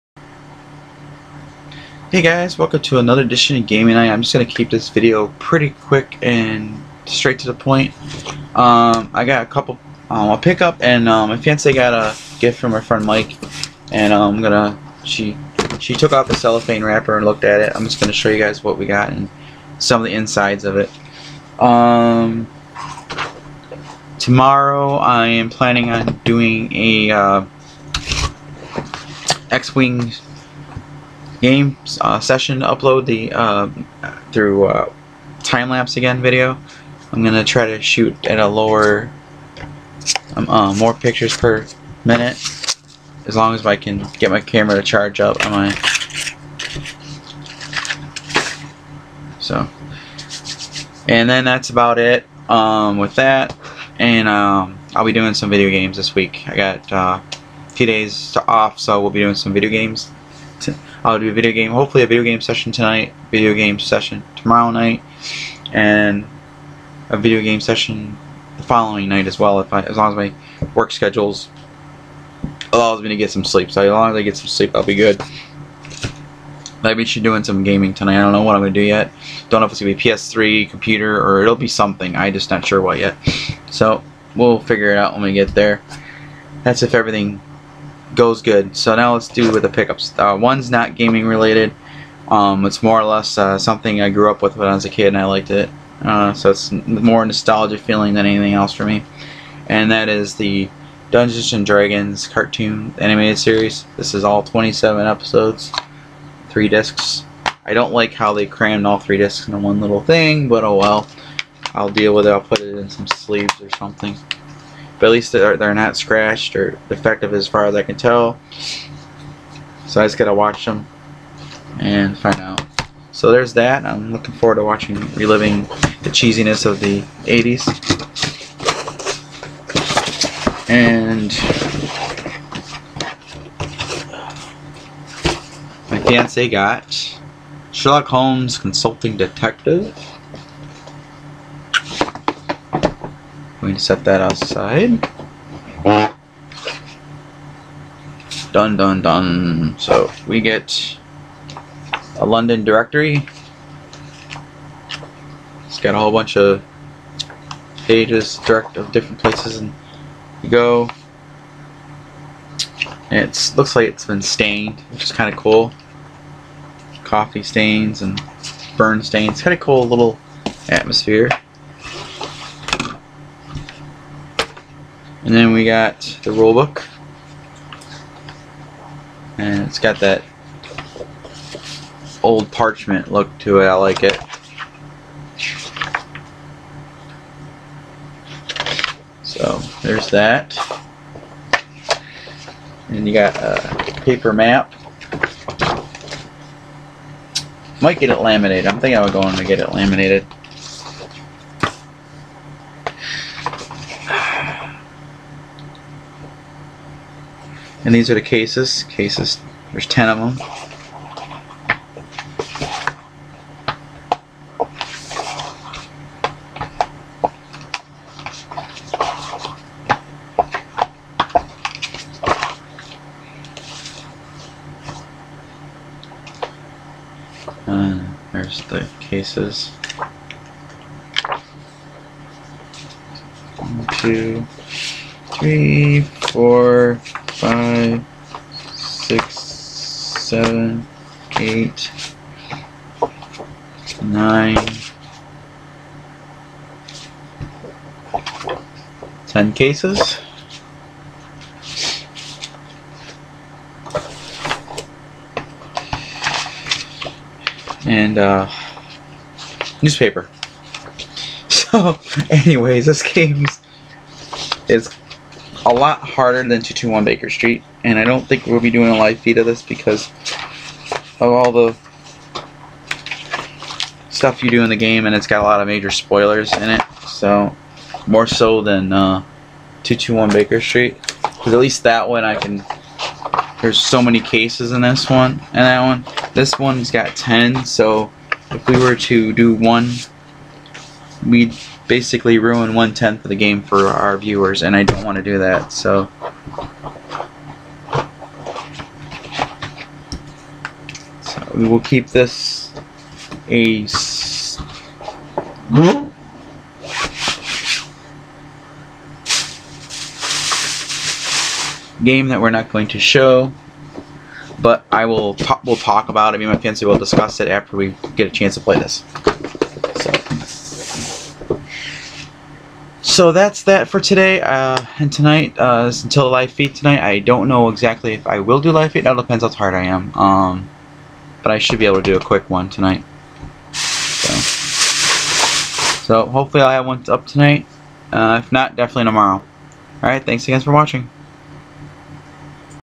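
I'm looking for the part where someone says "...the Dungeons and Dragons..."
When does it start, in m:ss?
1:40.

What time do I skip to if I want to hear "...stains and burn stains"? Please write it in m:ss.
2:47.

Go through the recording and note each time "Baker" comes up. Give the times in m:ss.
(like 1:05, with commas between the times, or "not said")
4:27, 4:40.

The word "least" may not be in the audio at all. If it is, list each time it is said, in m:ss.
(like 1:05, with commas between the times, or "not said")
1:55, 4:41.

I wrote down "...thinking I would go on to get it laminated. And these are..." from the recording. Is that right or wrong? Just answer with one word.
right.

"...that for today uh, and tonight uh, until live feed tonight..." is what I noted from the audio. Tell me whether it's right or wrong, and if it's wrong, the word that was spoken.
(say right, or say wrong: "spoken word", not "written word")
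right.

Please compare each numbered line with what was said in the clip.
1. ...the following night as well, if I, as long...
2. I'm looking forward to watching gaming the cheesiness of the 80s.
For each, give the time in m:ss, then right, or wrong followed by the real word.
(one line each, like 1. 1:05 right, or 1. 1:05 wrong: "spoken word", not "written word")
1. 1:08 right
2. 2:03 wrong: "reliving", not "gaming".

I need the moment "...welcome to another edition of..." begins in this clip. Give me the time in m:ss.
0:02.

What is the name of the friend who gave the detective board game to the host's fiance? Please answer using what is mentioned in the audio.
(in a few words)
Mike.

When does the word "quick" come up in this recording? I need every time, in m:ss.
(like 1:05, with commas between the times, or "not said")
0:05, 5:32.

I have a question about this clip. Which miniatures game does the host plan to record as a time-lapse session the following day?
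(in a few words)
X-Wing.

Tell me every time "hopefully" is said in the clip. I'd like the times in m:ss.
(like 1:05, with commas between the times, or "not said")
1:01, 5:36.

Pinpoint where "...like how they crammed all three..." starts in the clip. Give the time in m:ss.
1:47.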